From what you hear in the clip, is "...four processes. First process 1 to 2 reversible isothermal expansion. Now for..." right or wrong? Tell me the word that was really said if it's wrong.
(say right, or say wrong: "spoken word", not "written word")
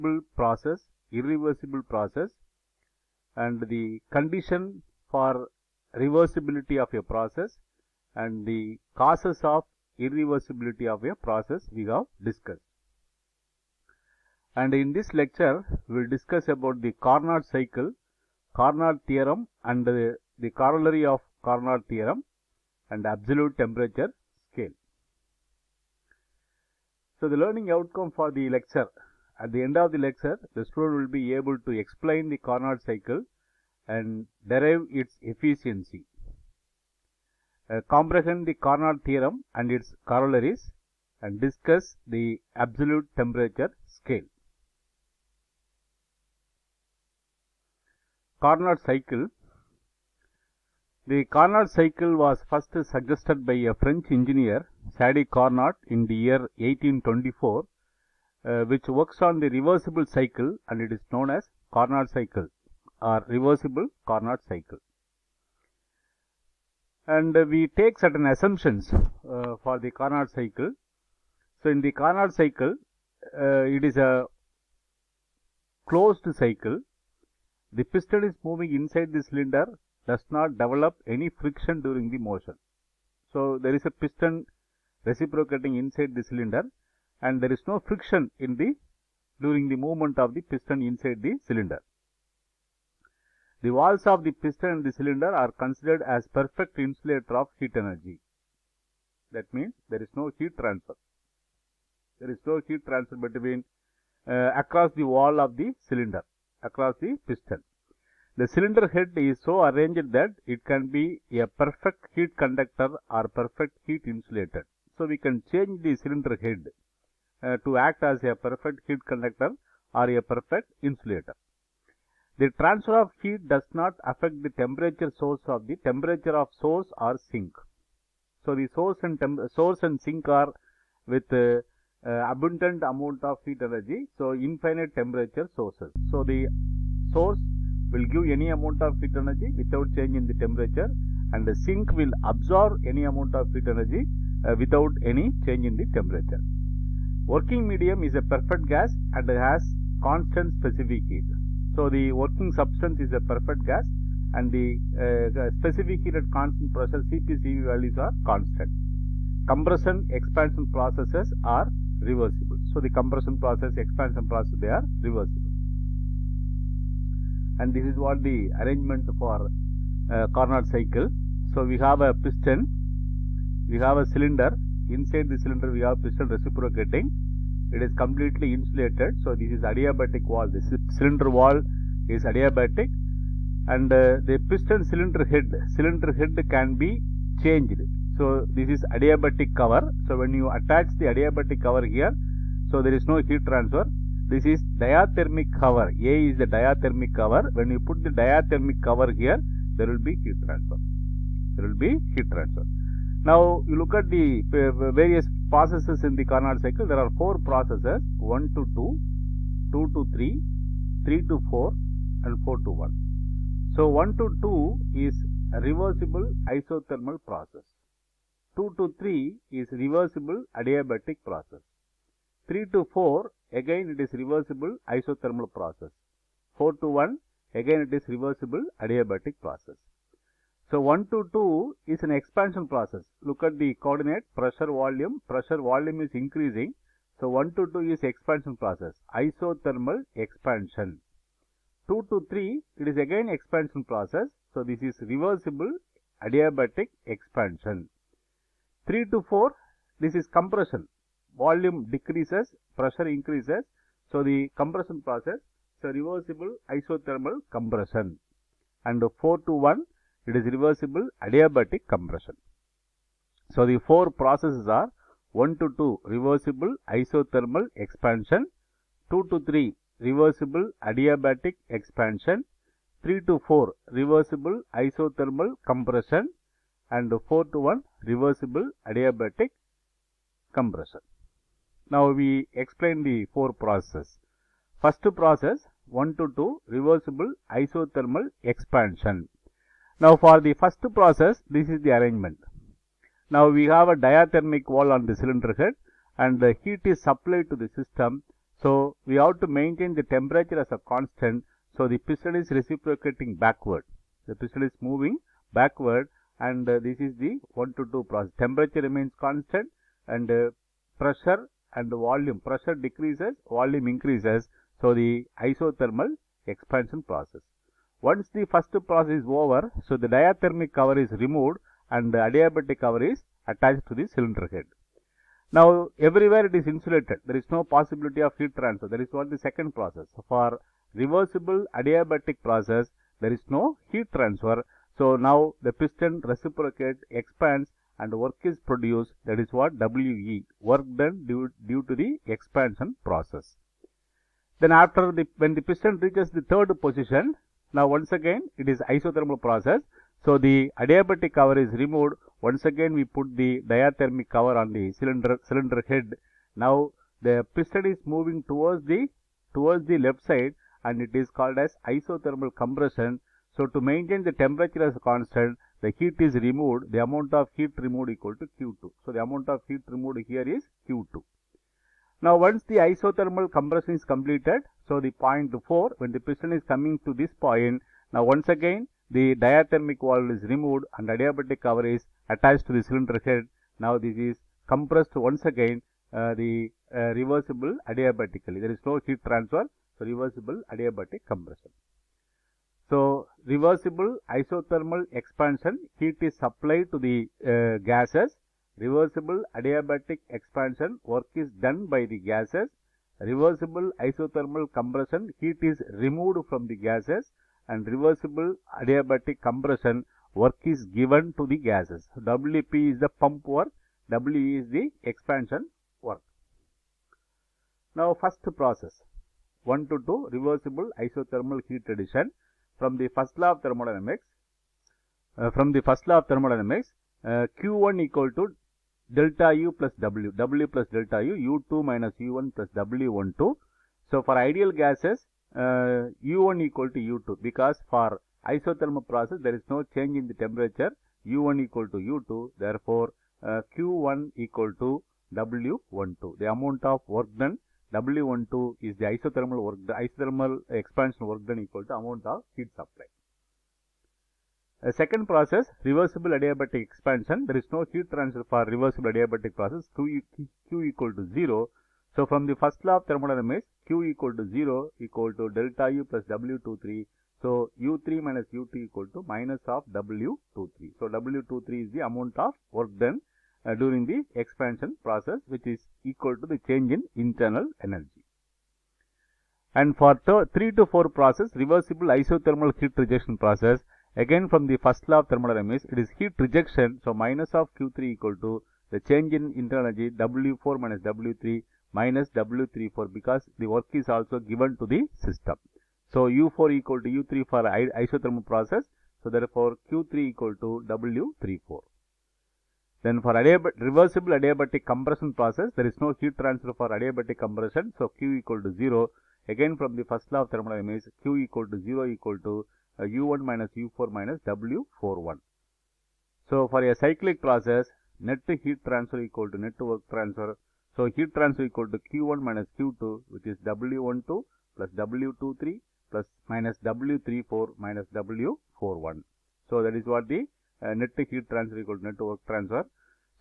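right.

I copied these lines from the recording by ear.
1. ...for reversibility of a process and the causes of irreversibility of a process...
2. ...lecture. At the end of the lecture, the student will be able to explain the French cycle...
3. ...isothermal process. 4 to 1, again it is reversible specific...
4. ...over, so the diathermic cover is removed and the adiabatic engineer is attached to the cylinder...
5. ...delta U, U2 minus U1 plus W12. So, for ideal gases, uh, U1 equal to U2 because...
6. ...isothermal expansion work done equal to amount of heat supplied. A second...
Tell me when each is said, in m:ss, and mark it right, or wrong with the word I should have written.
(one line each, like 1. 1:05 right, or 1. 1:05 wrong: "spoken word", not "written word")
1. 0:05 right
2. 0:28 wrong: "Carnot", not "French"
3. 3:44 wrong: "adiabatic", not "specific"
4. 5:19 wrong: "cover", not "engineer"
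5. 7:10 right
6. 7:29 right.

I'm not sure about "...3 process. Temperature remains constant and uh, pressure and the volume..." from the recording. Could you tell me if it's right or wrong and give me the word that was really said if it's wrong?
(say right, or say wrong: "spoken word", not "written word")
wrong: "2", not "3".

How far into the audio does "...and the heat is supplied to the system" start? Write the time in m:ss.
4:56.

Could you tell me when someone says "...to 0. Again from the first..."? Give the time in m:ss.
8:28.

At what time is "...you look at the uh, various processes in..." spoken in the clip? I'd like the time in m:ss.
3:23.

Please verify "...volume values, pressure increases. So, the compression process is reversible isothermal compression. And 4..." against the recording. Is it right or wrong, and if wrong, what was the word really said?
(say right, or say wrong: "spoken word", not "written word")
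wrong: "decreases", not "values".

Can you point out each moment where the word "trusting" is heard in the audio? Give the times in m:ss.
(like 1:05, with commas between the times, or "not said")
not said.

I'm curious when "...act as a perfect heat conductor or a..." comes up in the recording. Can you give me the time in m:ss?
1:57.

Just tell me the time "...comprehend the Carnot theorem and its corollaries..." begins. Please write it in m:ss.
0:37.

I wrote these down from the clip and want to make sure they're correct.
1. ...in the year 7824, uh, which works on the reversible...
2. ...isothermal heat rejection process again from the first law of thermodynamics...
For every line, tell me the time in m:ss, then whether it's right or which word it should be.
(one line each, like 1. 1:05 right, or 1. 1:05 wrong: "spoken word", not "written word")
1. 0:55 wrong: "1824", not "7824"
2. 8:02 right.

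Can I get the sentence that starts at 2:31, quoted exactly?
So, the working substance is a perfect gas and the uh, specific heat at constant pressure CPCV values are constant.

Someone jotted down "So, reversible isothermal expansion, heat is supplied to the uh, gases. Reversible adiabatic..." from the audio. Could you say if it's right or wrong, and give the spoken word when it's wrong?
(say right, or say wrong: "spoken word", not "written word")
right.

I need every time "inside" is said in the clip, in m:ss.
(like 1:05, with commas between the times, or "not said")
1:18, 1:25, 1:30, 2:54.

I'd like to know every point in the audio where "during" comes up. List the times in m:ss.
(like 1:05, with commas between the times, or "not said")
1:21, 1:29, 7:53.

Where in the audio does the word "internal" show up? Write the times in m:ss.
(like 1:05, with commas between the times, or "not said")
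7:57, 8:09.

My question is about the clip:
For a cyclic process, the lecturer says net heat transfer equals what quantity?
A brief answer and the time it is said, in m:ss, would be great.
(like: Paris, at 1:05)
Net work transfer, at 8:39.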